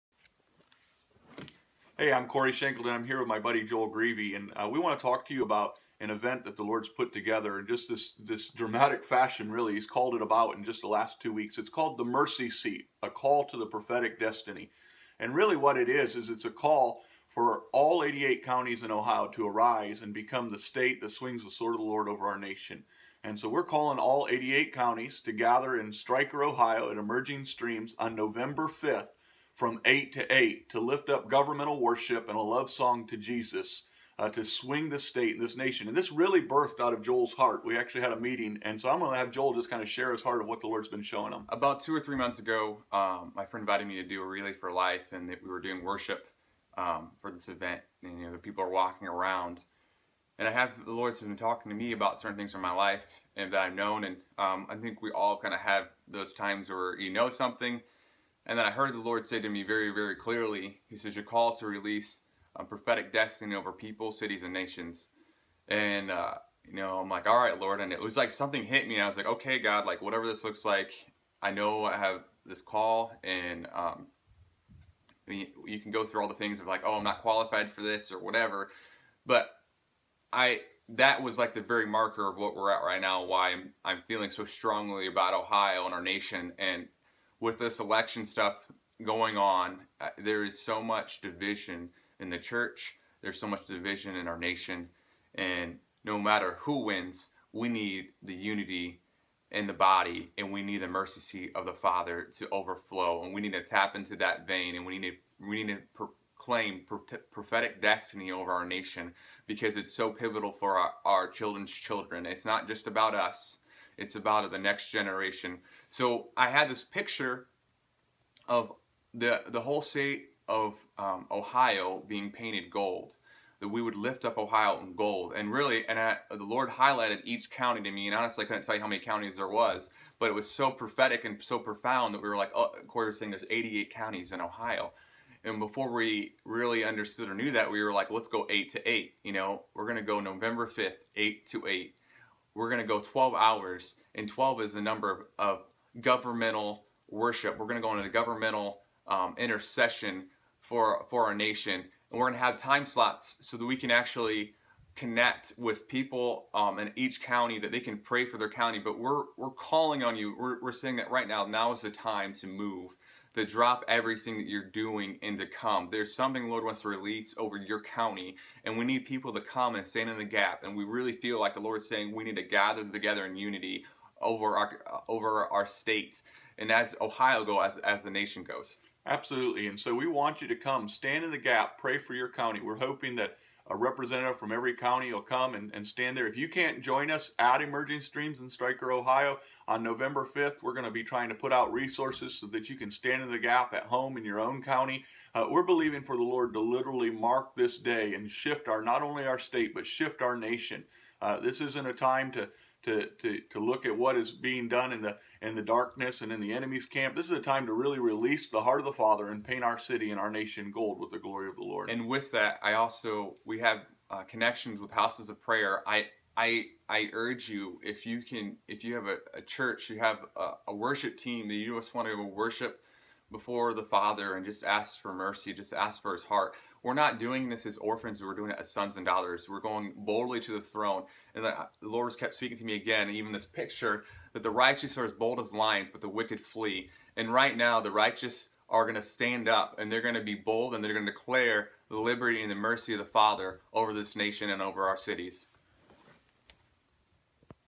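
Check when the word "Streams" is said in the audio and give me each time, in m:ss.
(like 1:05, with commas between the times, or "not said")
0:27, 3:08.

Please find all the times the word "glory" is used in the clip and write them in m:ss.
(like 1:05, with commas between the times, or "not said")
3:31.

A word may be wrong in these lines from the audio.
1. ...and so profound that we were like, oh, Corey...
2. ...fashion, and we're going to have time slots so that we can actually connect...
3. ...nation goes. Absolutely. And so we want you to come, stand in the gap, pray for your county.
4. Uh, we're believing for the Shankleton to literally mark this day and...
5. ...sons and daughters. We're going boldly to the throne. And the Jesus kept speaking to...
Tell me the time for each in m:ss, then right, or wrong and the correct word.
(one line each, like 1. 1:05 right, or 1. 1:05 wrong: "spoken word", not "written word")
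1. 2:11 right
2. 2:31 wrong: "nation", not "fashion"
3. 2:58 right
4. 3:15 wrong: "Lord", not "Shankleton"
5. 3:48 wrong: "Lord", not "Jesus".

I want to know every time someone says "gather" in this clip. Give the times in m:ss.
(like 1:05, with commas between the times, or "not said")
0:25, 2:52.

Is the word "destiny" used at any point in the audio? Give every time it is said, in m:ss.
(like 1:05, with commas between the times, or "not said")
0:14, 1:03, 1:47.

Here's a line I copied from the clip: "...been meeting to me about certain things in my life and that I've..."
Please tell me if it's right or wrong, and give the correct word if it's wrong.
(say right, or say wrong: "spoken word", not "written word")
wrong: "talking", not "meeting".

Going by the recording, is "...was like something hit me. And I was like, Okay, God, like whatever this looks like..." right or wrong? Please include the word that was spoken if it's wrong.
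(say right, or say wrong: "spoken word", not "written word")
right.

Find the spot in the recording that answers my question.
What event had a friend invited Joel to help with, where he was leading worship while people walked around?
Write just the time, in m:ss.
0:44.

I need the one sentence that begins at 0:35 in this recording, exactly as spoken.
And this really birthed out of Joel's heart.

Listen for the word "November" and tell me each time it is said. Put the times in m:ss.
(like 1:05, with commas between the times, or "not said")
0:28, 2:20, 3:09.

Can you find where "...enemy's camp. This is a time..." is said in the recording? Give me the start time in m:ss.
3:26.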